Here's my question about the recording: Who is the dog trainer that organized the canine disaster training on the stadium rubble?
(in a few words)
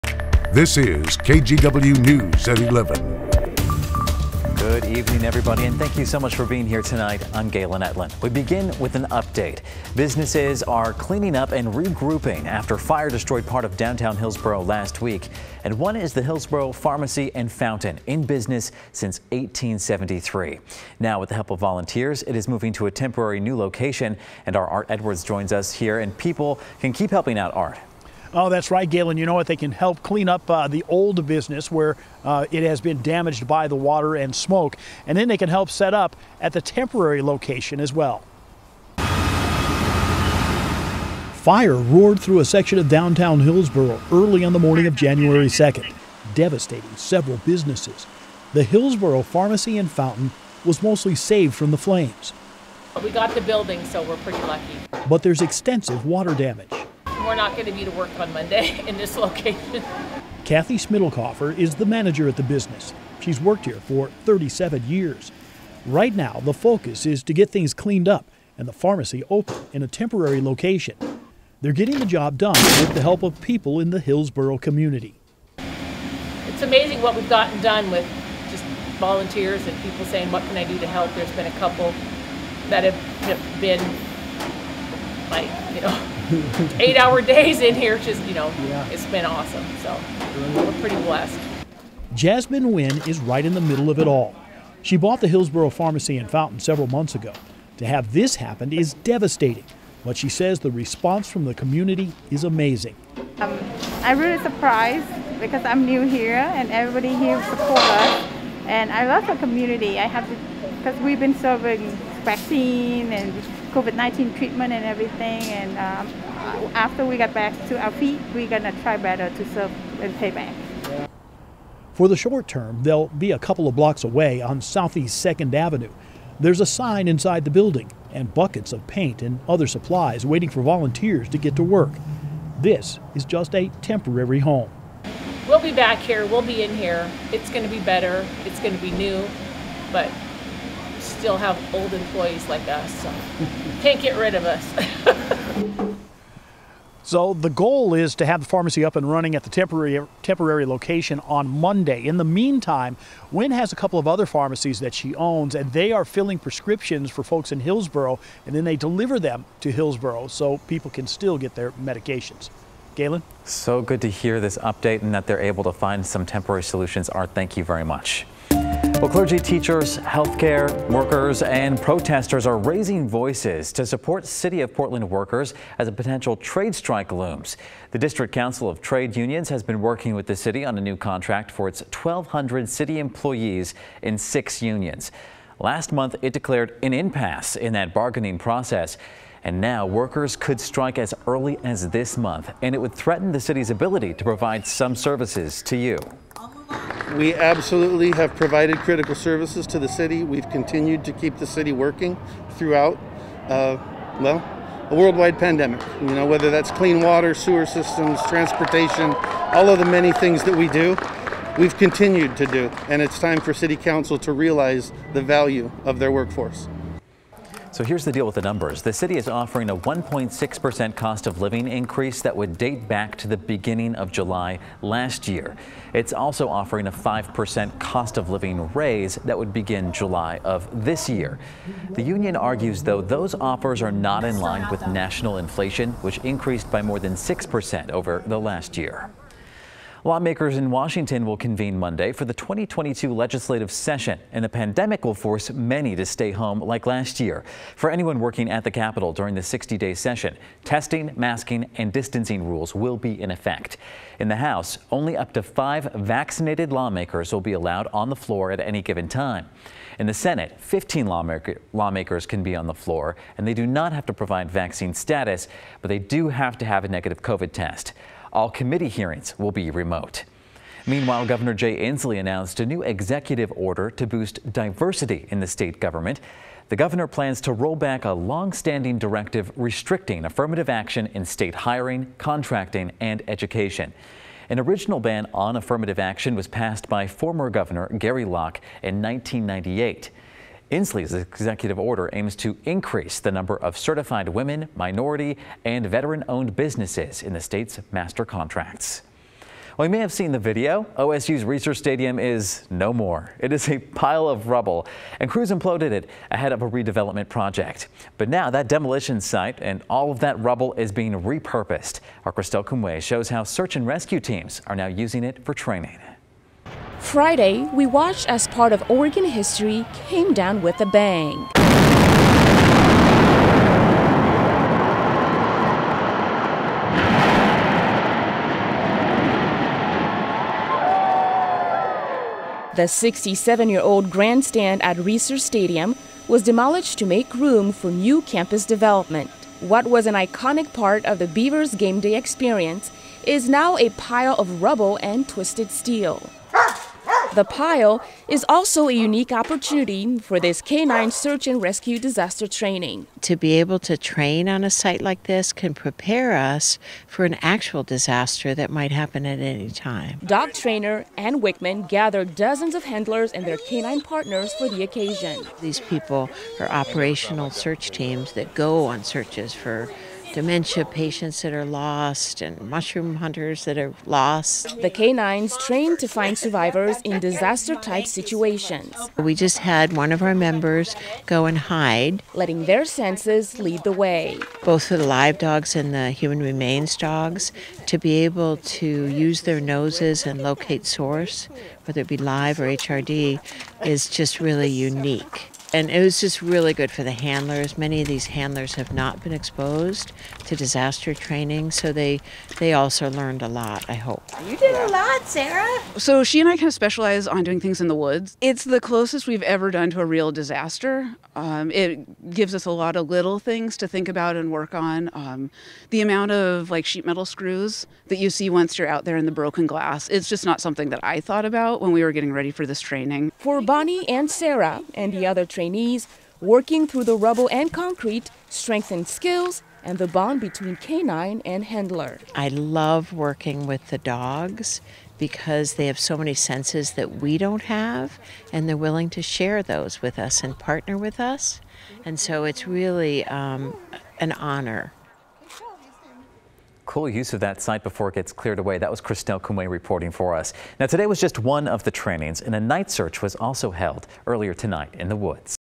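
Ann Wickman.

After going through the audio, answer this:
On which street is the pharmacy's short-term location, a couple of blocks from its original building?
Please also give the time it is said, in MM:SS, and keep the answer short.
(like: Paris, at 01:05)
Southeast 2nd Avenue, at 02:04.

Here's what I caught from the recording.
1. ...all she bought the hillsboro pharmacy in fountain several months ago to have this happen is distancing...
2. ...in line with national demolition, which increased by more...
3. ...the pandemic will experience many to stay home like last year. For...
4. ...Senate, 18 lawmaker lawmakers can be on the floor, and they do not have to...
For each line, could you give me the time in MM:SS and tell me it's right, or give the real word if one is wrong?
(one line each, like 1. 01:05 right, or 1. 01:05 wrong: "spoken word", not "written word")
1. 01:34 wrong: "devastating", not "distancing"
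2. 03:54 wrong: "inflation", not "demolition"
3. 04:04 wrong: "force", not "experience"
4. 04:20 wrong: "15", not "18".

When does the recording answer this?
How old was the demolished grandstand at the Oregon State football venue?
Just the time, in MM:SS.
05:32.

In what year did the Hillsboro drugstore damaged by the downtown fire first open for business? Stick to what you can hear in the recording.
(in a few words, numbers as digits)
1873.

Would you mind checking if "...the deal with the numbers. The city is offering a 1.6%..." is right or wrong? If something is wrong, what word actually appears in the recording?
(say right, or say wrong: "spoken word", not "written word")
right.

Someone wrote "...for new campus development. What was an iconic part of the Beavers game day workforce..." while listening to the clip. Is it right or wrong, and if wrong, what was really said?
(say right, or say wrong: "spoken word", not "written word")
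wrong: "experience", not "workforce".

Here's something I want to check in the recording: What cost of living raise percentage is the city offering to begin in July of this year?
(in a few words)
5%.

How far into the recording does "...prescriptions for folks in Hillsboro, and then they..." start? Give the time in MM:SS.
02:36.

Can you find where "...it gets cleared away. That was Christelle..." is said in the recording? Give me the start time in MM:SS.
07:28.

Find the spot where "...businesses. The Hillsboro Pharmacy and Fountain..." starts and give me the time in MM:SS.
00:47.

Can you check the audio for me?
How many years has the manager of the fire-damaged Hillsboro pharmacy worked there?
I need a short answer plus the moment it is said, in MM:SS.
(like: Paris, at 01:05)
37, at 01:04.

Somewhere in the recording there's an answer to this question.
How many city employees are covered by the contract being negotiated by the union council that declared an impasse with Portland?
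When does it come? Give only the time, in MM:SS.
03:01.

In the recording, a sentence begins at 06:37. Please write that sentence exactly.
Many of these handlers have not been exposed to disaster training, so they they also learned a lot.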